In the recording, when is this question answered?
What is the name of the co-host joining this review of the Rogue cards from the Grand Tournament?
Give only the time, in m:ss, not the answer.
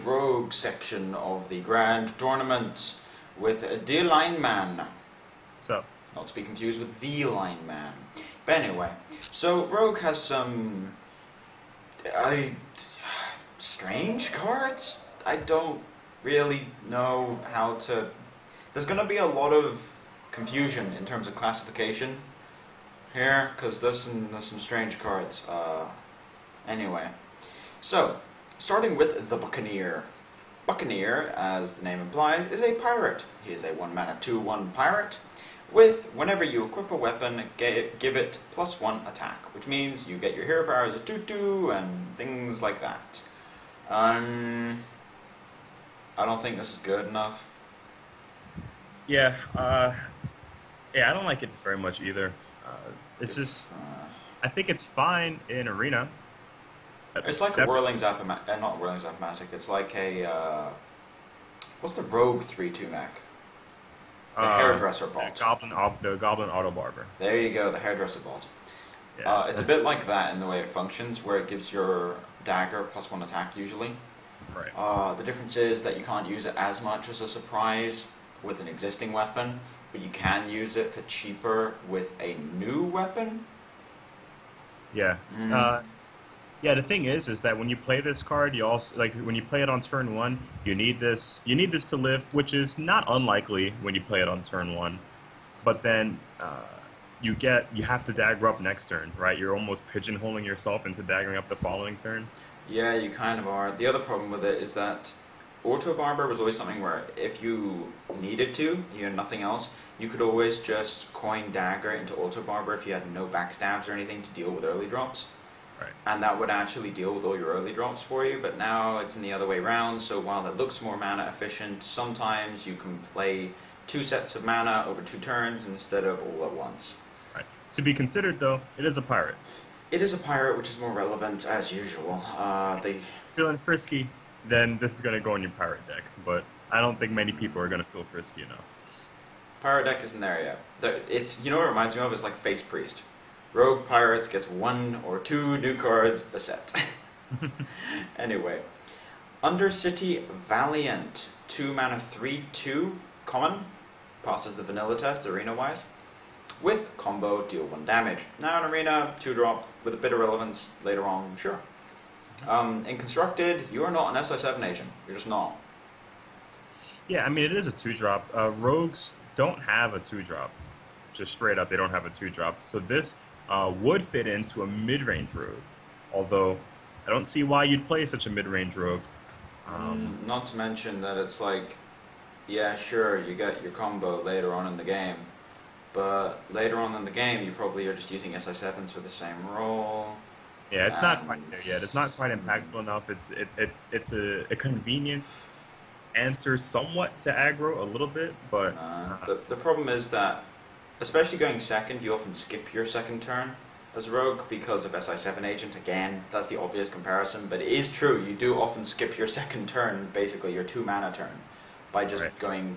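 0:03.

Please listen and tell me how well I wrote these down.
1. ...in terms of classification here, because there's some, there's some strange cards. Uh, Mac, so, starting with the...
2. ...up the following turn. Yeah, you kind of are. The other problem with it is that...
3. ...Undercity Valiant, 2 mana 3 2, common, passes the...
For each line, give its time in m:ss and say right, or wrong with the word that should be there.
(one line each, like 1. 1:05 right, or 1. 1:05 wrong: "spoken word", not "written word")
1. 0:20 wrong: "Anyway", not "Mac"
2. 1:41 right
3. 2:29 right.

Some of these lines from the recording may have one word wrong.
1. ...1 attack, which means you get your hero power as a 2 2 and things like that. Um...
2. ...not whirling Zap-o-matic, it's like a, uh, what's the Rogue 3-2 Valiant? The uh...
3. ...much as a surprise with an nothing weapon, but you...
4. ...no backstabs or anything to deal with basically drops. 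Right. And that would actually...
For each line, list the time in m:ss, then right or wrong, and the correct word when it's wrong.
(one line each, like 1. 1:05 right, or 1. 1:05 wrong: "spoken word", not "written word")
1. 0:38 right
2. 0:58 wrong: "Mac", not "Valiant"
3. 1:16 wrong: "existing", not "nothing"
4. 1:53 wrong: "early", not "basically".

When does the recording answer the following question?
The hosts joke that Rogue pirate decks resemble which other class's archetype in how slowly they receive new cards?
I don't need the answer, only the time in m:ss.
2:22.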